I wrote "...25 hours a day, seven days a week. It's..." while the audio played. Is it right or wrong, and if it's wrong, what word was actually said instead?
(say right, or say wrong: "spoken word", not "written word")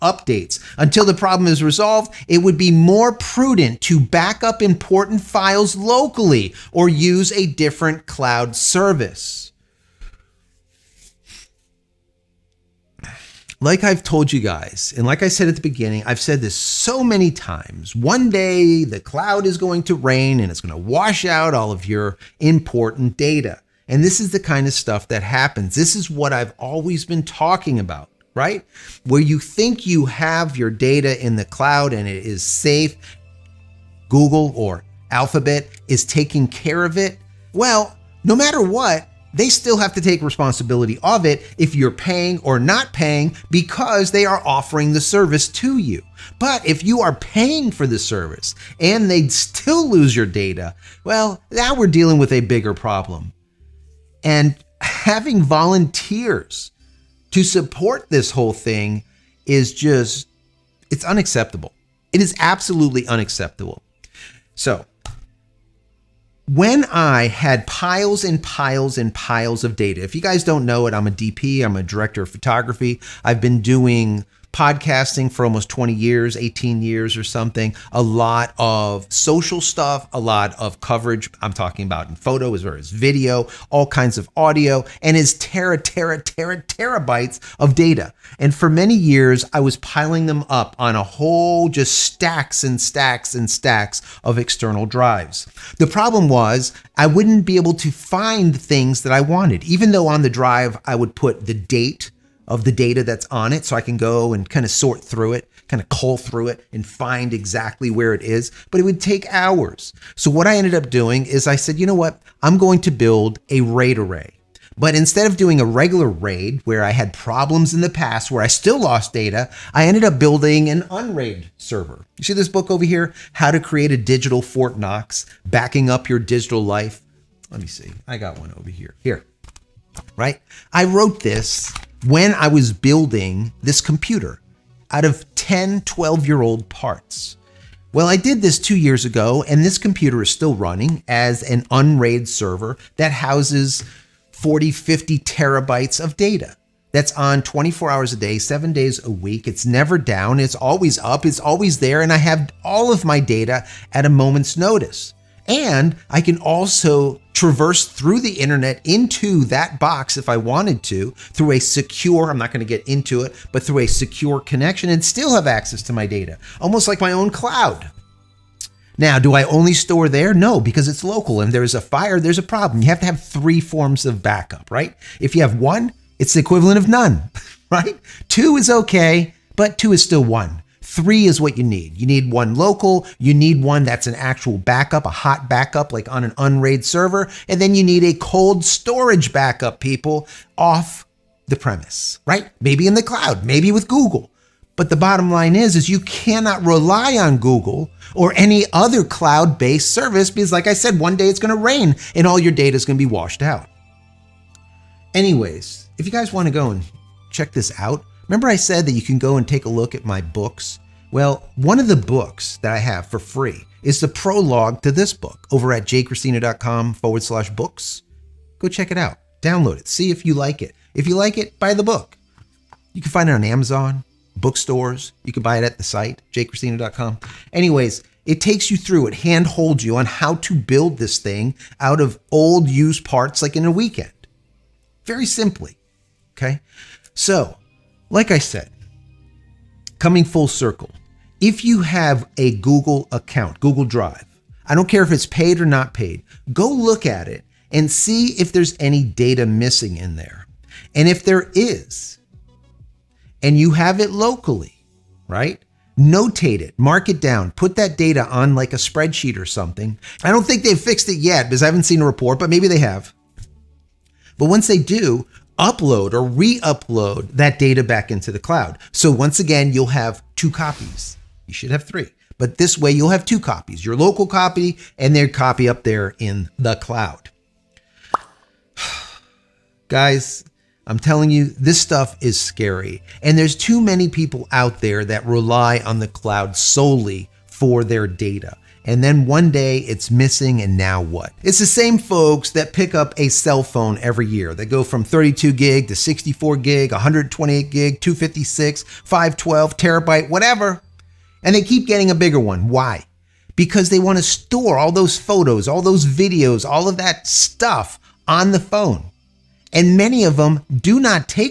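wrong: "24", not "25".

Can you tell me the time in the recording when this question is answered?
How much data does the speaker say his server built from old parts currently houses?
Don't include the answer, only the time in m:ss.
2:24.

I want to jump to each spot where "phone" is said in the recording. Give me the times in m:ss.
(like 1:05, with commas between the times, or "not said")
4:53, 5:08.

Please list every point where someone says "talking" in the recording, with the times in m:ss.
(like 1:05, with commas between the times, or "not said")
0:27, 1:21.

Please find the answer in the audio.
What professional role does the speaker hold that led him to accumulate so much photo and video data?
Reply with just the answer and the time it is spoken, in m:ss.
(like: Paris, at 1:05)
Director of photography, at 1:11.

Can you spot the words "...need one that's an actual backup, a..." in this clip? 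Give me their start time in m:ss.
3:03.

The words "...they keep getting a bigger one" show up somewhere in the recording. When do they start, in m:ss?
5:01.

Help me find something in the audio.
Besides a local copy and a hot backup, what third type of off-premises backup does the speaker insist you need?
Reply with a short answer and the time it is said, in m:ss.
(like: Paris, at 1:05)
Cold storage backup, at 3:08.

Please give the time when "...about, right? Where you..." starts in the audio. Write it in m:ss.
0:27.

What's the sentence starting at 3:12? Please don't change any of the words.
Maybe in the cloud, maybe with Google.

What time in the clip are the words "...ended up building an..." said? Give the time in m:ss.
1:59.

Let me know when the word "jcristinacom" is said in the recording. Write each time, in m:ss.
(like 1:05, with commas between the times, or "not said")
3:35, 3:46.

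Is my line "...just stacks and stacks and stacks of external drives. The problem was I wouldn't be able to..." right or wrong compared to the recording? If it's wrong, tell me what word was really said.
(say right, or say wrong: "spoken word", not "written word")
right.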